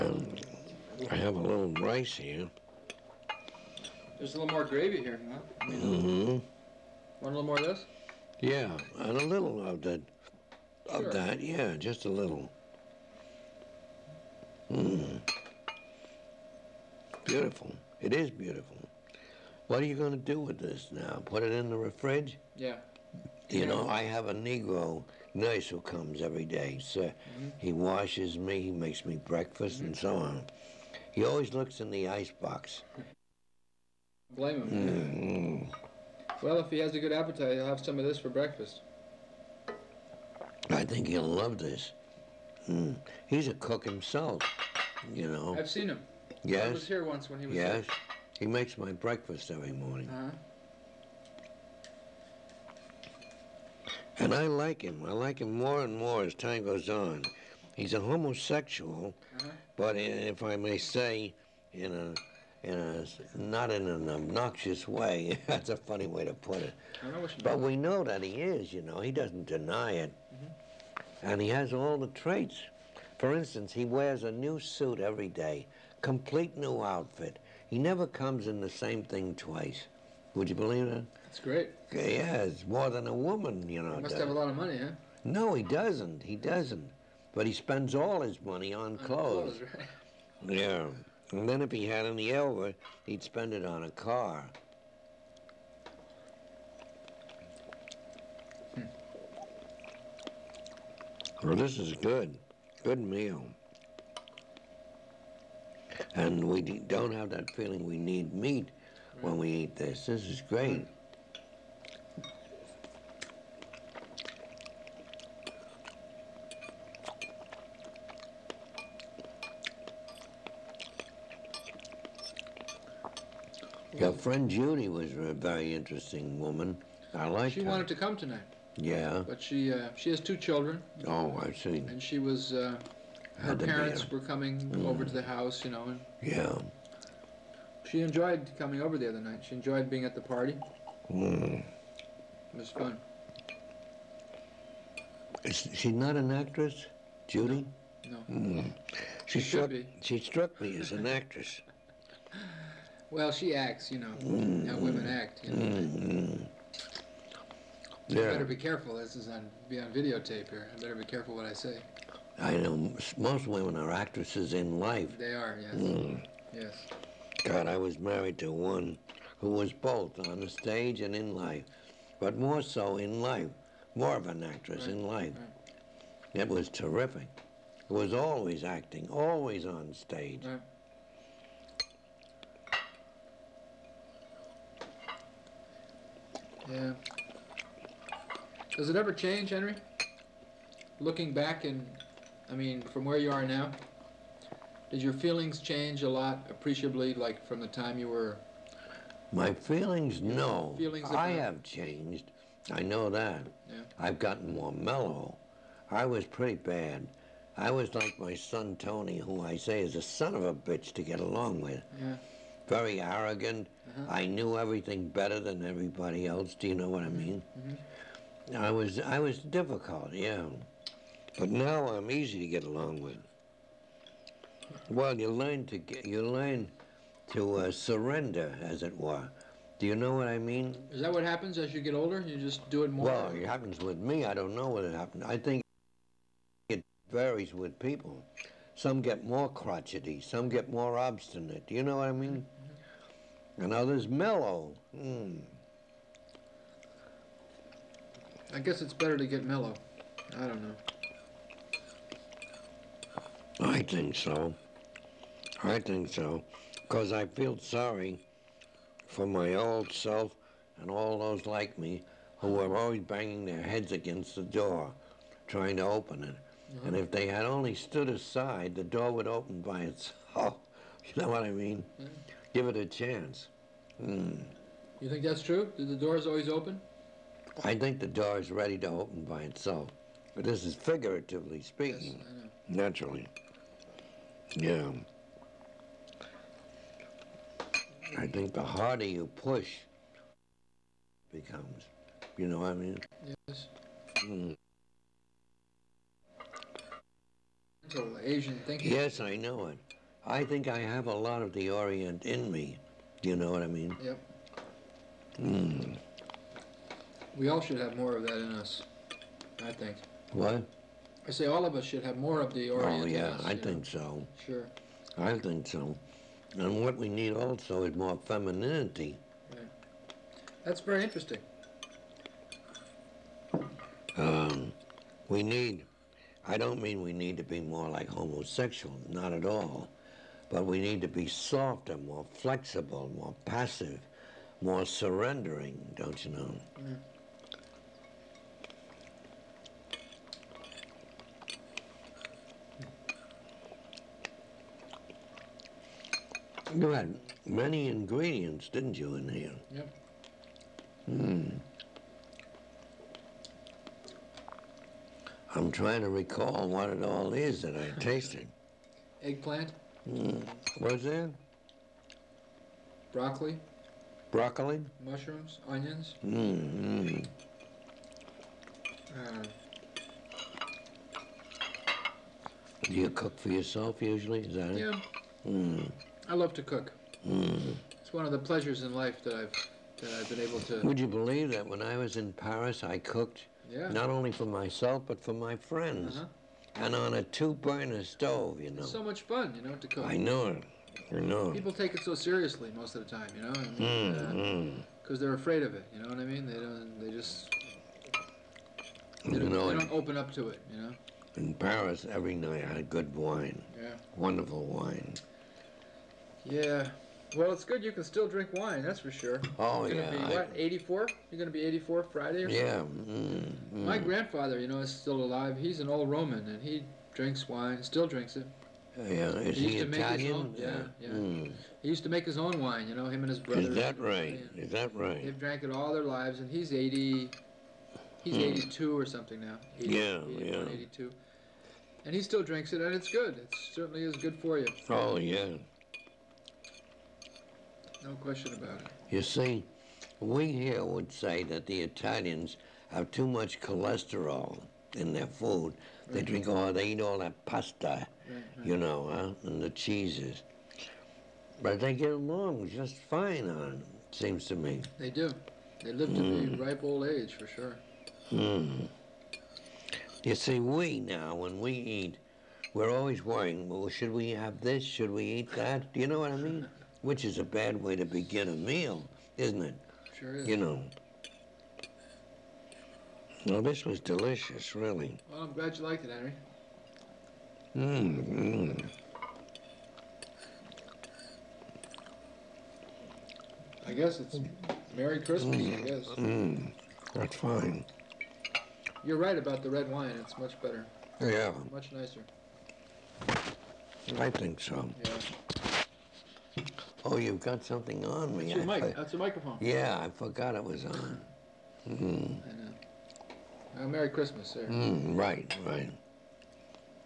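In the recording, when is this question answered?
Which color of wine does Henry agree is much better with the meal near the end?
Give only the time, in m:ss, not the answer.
8:09.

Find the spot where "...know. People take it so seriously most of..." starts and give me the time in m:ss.
6:31.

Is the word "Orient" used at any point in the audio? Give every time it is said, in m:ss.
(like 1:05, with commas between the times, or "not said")
5:01, 5:12.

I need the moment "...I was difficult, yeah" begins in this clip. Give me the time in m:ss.
3:38.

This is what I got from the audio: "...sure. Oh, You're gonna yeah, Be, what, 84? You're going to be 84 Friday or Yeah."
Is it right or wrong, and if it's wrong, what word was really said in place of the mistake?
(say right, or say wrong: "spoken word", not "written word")
right.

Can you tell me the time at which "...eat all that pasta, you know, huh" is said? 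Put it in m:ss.
7:26.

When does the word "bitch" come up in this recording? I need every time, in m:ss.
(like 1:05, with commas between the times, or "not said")
3:30.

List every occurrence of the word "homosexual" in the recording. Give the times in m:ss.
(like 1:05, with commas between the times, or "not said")
0:57, 5:28.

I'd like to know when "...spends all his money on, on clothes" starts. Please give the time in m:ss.
1:27.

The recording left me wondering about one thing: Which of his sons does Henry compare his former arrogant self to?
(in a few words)
Tony.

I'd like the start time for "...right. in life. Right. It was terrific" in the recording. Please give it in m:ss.
2:54.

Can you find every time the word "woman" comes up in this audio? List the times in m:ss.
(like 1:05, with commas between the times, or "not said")
1:23, 2:06.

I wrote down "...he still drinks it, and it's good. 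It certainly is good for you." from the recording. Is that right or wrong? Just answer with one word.
right.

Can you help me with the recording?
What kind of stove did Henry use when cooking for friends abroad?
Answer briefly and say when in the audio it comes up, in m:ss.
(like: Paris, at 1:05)
two-burner, at 6:27.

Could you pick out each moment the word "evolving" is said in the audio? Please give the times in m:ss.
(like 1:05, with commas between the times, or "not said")
not said.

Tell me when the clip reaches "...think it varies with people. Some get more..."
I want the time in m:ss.
3:55.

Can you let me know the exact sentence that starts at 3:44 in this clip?
Well, you learn to get, you learn to uh, surrender, as it were.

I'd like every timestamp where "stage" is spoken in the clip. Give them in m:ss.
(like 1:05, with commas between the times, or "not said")
2:50, 2:59.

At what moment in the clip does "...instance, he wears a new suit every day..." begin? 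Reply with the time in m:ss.
1:13.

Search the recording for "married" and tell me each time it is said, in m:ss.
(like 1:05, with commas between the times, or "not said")
2:47.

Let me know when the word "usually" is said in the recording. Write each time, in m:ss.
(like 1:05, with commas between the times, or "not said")
6:13.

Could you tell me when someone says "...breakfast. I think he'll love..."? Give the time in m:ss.
0:38.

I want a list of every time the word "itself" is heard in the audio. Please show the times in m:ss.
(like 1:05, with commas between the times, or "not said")
4:29, 4:39.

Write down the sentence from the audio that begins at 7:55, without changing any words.
Well, I'm glad you liked it, Henry.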